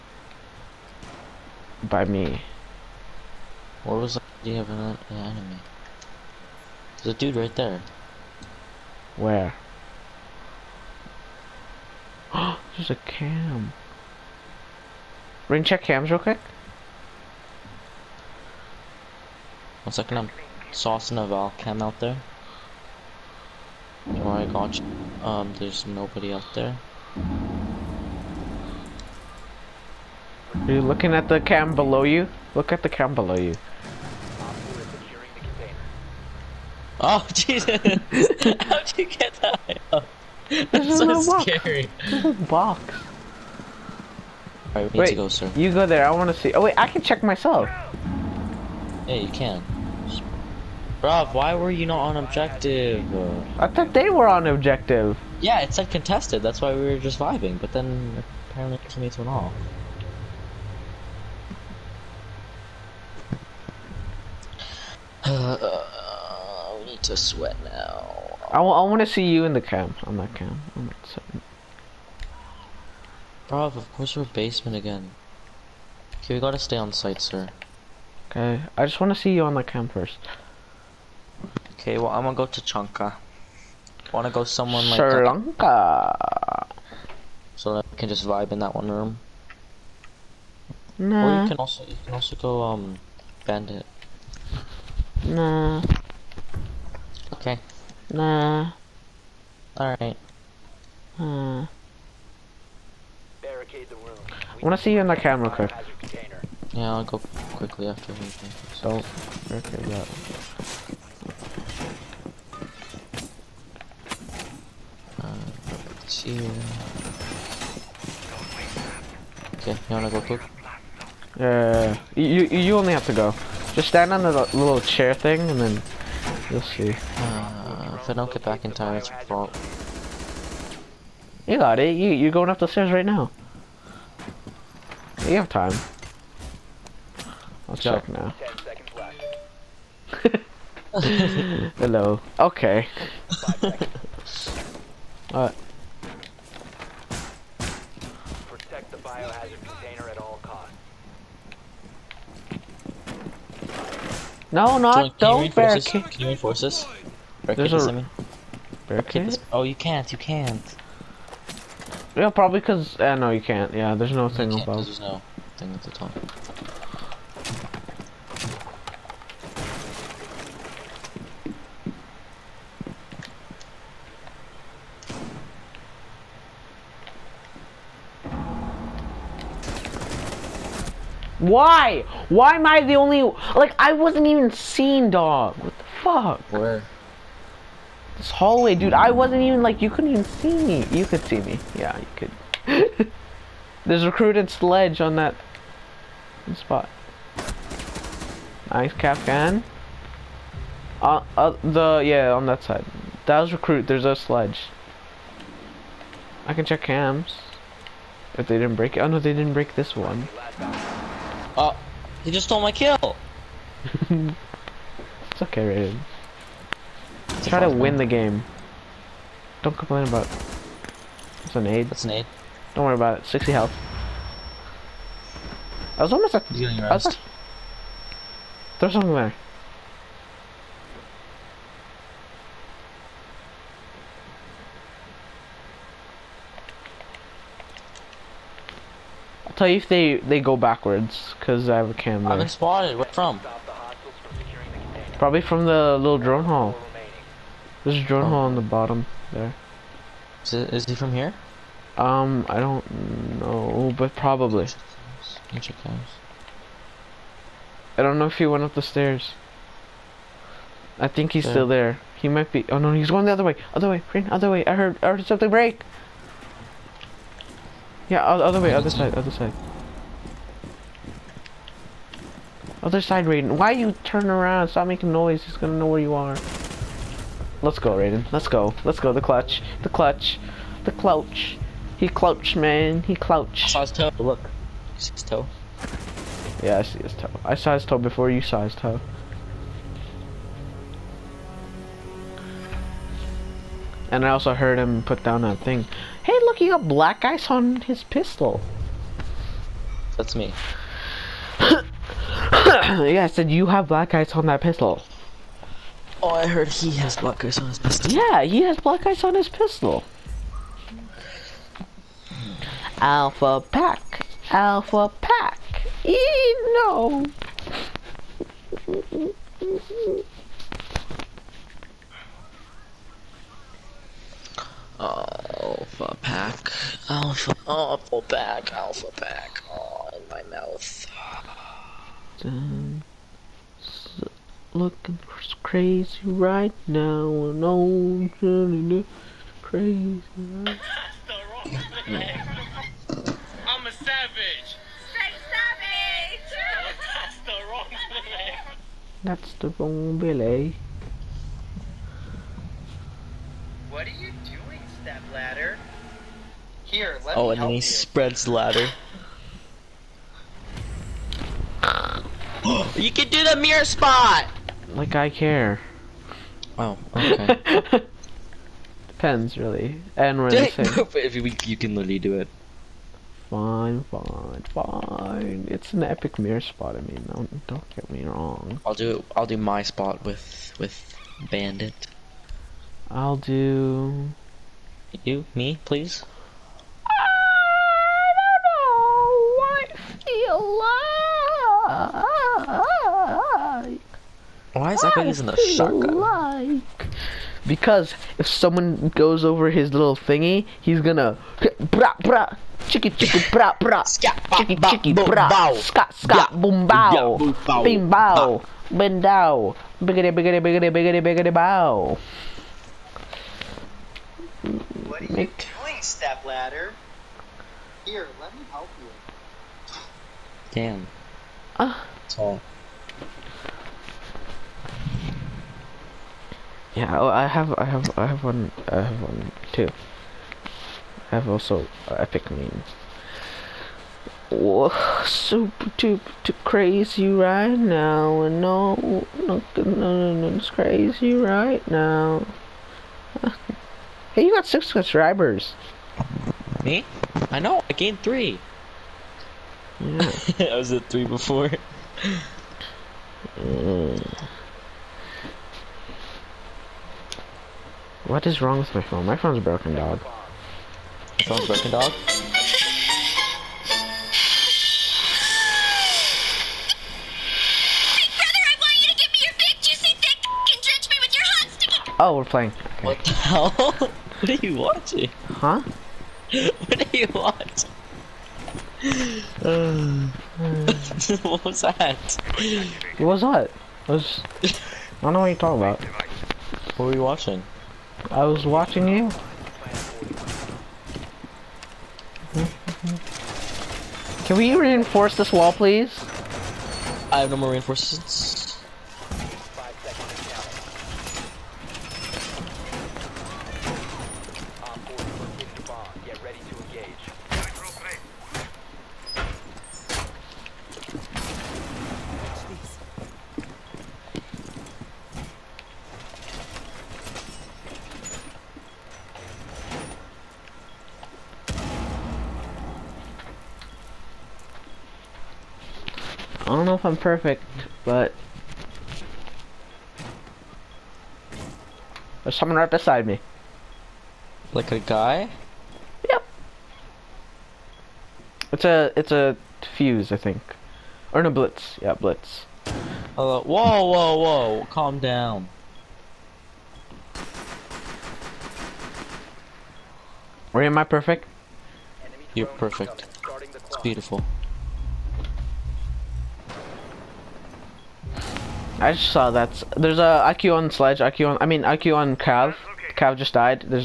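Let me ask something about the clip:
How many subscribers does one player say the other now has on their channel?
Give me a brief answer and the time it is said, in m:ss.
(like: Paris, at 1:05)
6, at 7:24.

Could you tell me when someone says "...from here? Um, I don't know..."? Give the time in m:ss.
4:10.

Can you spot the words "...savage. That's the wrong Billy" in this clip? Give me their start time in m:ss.
5:45.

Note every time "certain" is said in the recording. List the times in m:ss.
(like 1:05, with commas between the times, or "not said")
not said.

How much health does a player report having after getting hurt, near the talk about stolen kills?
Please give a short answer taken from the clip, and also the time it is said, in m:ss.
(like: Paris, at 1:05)
60, at 3:43.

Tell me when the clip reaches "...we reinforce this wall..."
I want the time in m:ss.
8:14.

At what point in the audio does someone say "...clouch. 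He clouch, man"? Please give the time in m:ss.
4:40.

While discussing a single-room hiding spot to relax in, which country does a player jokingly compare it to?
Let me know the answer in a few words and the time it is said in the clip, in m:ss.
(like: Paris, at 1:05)
Sri Lanka, at 1:25.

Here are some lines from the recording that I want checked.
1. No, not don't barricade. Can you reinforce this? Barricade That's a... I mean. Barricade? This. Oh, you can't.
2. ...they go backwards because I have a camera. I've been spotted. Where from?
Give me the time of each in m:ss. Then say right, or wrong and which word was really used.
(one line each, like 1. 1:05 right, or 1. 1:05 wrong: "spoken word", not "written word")
1. 2:34 wrong: "There", not "That"
2. 4:00 right.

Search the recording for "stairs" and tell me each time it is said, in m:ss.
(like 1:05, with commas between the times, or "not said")
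2:12, 4:18.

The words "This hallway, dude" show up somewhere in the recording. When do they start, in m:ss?
3:08.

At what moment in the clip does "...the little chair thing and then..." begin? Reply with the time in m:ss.
2:04.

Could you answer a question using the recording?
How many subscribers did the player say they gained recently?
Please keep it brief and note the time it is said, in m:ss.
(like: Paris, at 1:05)
3, at 7:27.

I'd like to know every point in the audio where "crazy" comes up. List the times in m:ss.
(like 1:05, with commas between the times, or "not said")
5:35, 5:39, 7:16, 7:20.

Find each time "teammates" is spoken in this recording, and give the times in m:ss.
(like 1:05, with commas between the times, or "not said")
0:58.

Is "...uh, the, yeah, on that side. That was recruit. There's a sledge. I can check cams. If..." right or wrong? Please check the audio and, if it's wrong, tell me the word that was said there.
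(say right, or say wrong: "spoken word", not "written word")
right.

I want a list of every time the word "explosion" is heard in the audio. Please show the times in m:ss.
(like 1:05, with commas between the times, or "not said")
not said.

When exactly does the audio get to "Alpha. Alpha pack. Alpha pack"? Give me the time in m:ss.
5:27.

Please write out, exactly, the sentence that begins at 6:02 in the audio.
you can do the mirror spot.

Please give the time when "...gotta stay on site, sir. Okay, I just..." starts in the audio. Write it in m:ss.
1:16.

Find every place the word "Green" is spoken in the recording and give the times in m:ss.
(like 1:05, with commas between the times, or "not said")
4:24.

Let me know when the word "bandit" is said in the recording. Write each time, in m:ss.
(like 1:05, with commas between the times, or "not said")
1:33, 6:21.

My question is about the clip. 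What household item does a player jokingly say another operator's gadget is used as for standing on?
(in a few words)
Step ladder.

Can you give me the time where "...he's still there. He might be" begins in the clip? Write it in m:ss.
4:21.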